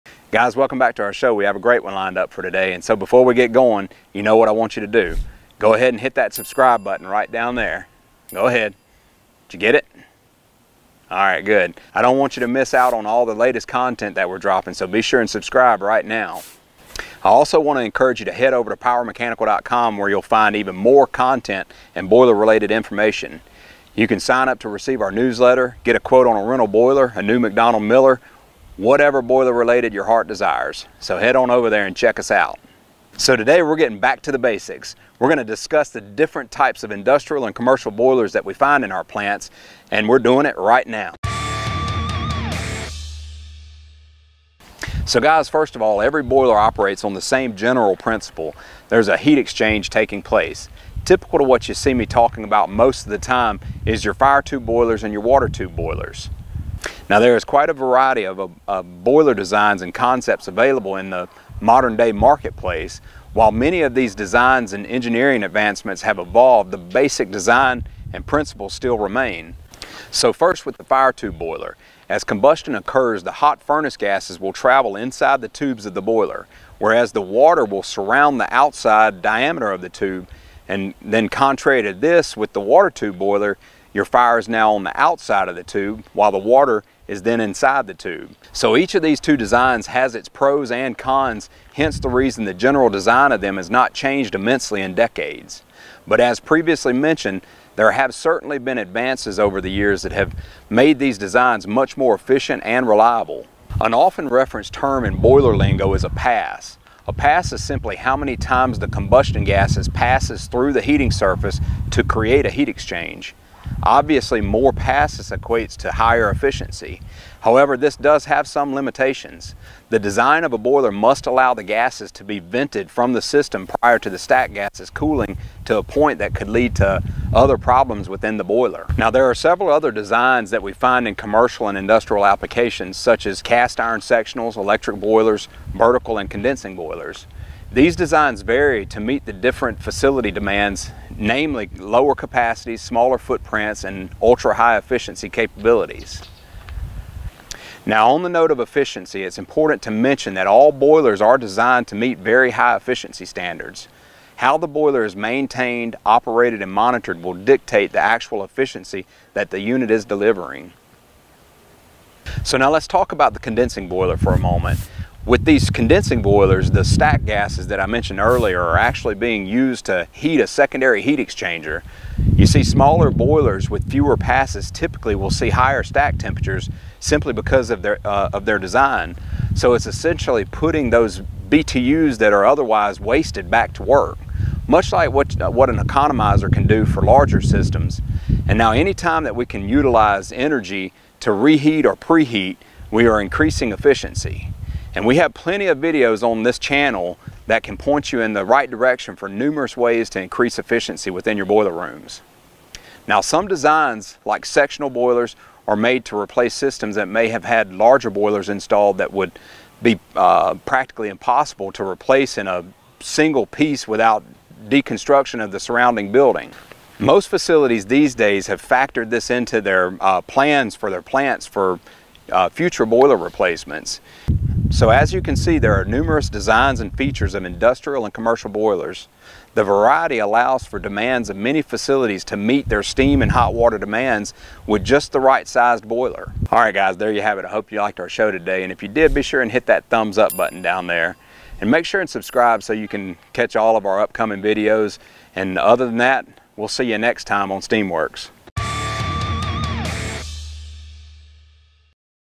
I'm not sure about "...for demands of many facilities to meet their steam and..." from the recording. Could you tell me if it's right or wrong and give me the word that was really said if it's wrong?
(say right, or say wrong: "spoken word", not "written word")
right.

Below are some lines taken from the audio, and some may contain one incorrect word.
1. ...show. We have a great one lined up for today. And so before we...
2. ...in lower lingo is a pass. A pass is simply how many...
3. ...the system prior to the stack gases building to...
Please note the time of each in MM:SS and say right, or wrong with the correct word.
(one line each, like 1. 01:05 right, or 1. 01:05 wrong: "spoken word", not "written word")
1. 00:01 right
2. 01:45 wrong: "boiler", not "lower"
3. 02:03 wrong: "cooling", not "building".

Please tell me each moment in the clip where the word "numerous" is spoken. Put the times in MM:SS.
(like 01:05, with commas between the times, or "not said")
03:19, 03:45.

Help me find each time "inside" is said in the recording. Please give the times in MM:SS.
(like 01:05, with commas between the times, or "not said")
01:14, 01:27.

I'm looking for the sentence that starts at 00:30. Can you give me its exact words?
So head on over there and check us out.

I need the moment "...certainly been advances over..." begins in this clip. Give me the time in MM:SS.
01:38.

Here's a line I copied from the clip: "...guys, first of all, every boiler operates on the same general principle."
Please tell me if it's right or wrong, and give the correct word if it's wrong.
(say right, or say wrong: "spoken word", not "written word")
right.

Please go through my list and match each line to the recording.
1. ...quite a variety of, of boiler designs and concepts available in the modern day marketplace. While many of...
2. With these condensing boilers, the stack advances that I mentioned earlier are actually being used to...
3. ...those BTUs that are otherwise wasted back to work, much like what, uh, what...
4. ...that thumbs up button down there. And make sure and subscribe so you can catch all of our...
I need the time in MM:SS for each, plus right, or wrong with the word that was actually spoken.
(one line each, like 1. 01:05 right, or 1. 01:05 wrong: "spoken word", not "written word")
1. 00:57 right
2. 02:45 wrong: "gases", not "advances"
3. 03:00 right
4. 03:59 right.